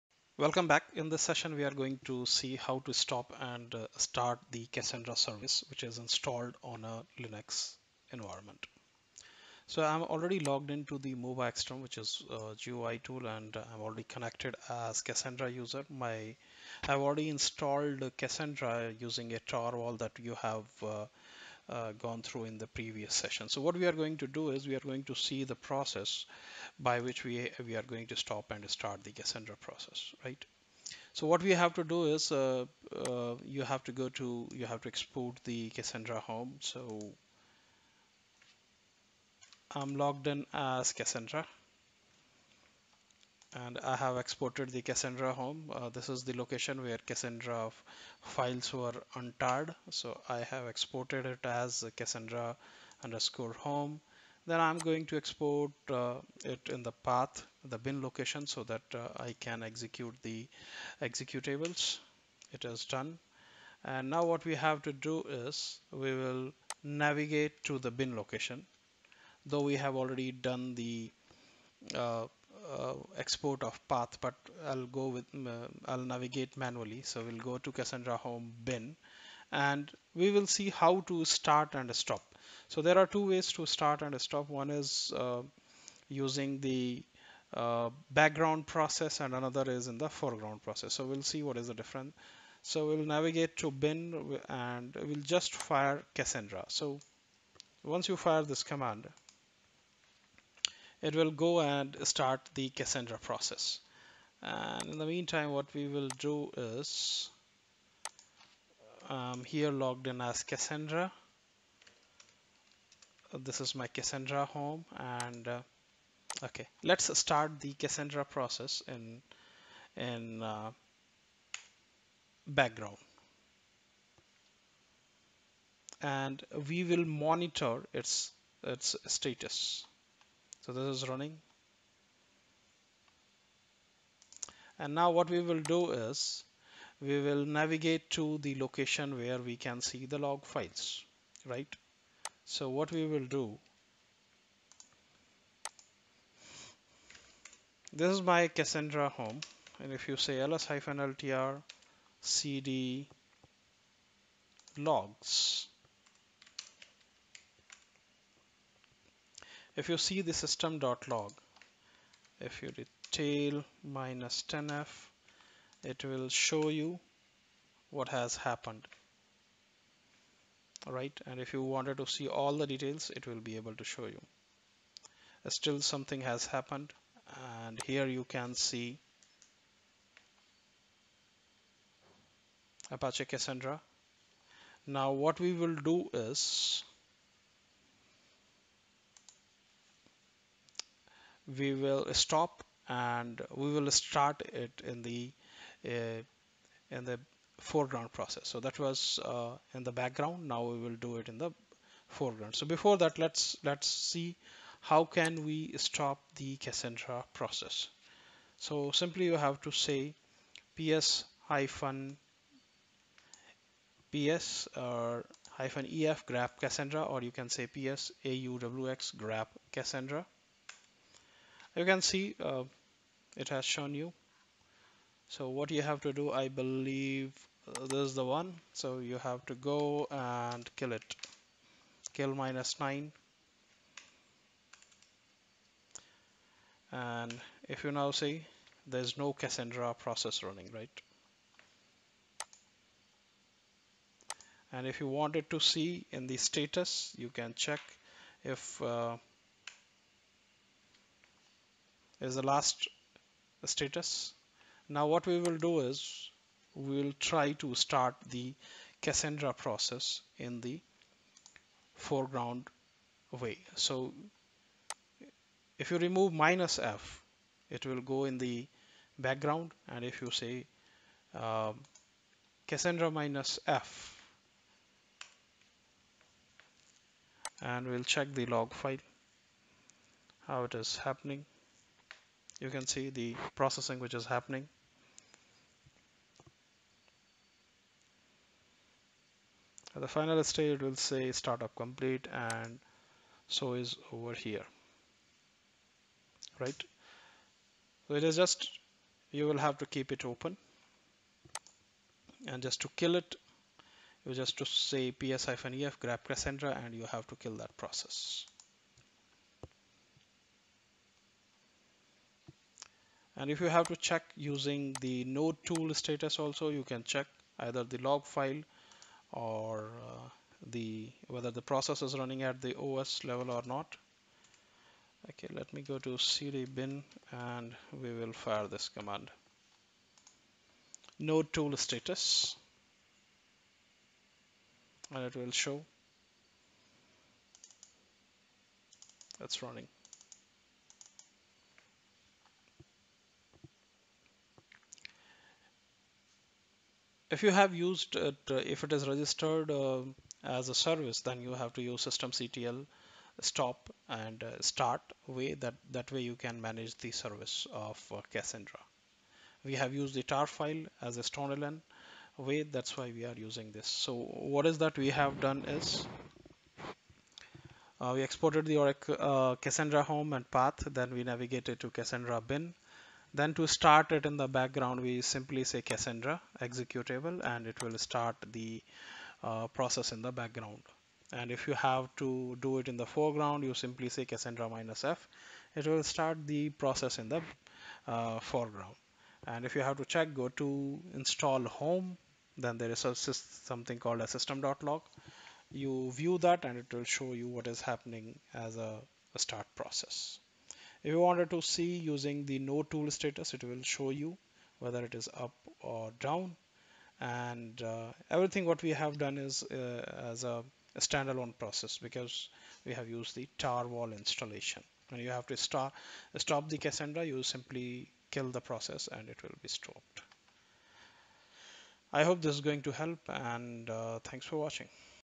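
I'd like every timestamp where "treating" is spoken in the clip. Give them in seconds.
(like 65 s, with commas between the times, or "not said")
not said.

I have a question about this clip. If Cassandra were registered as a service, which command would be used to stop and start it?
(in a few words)
systemctl.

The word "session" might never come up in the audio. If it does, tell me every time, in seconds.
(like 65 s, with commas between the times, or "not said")
1 s, 23 s.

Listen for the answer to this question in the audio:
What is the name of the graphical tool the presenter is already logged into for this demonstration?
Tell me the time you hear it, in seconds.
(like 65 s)
11 s.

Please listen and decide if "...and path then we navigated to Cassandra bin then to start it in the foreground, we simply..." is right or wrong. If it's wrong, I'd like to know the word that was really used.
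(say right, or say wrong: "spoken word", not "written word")
wrong: "background", not "foreground".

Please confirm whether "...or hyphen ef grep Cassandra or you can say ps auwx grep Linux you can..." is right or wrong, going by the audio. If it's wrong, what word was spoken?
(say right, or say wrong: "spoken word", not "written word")
wrong: "Cassandra", not "Linux".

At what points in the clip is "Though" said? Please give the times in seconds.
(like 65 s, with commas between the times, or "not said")
69 s.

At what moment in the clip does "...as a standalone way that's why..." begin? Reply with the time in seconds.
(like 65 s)
361 s.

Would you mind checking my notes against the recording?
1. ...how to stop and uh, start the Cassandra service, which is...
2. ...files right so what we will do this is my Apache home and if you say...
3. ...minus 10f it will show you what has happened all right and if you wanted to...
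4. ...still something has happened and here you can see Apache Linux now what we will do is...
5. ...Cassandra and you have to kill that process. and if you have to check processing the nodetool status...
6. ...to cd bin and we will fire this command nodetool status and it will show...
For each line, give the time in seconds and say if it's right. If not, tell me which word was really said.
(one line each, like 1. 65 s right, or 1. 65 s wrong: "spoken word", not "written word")
1. 2 s right
2. 140 s wrong: "Cassandra", not "Apache"
3. 163 s right
4. 175 s wrong: "Cassandra", not "Linux"
5. 306 s wrong: "using", not "processing"
6. 325 s right.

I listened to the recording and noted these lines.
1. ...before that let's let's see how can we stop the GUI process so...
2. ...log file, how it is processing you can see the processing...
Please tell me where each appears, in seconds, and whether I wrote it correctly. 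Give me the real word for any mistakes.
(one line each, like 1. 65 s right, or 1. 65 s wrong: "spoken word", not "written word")
1. 202 s wrong: "Cassandra", not "GUI"
2. 278 s wrong: "happening", not "processing".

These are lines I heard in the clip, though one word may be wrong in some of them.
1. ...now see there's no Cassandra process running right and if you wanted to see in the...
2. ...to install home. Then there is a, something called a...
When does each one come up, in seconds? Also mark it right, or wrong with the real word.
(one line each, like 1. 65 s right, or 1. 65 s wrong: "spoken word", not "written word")
1. 237 s right
2. 390 s right.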